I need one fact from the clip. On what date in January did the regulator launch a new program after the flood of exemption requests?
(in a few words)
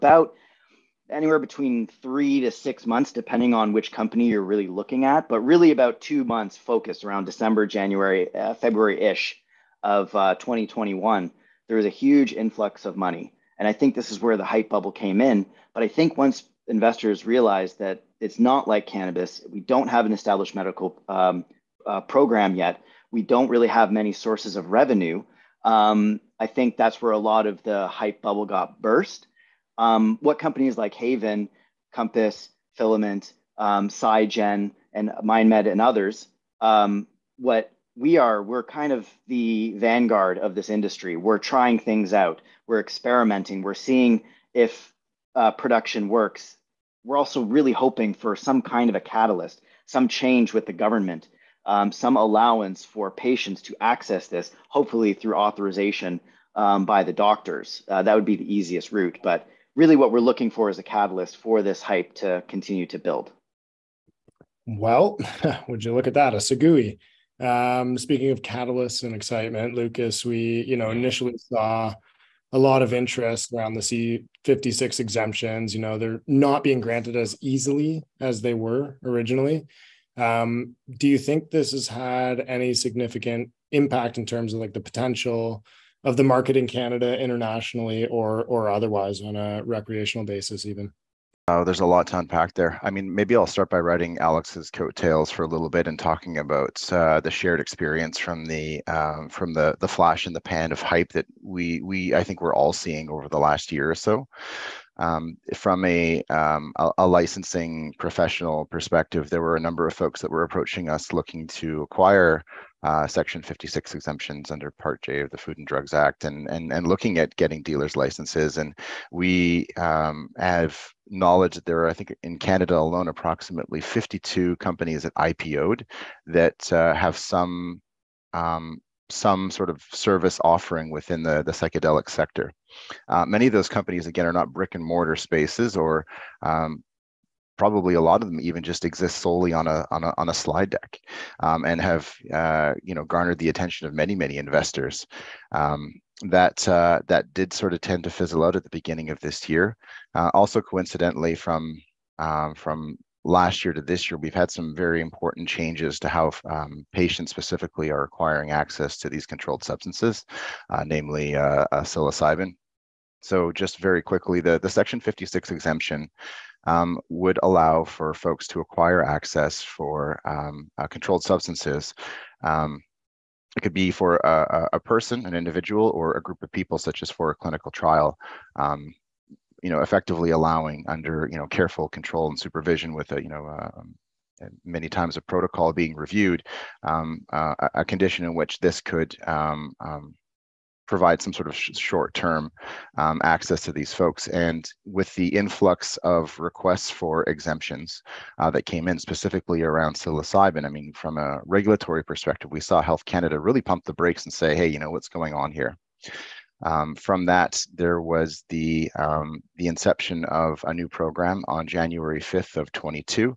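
January 5th.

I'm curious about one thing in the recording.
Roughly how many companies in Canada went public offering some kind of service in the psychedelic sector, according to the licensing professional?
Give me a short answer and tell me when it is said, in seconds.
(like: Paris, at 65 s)
52, at 123 s.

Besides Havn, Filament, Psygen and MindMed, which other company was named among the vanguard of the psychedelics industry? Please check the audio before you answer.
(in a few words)
Compass.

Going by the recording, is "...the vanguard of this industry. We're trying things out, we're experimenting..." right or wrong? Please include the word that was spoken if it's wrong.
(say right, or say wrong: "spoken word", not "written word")
right.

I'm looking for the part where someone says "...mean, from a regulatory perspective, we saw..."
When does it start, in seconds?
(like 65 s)
200 s.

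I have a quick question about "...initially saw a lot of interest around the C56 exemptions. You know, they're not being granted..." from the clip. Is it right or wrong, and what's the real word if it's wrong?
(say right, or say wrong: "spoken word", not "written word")
right.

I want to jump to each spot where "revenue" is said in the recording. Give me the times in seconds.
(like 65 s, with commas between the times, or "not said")
24 s.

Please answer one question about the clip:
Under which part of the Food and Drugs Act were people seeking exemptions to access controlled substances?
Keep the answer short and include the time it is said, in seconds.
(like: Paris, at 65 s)
Part J, at 114 s.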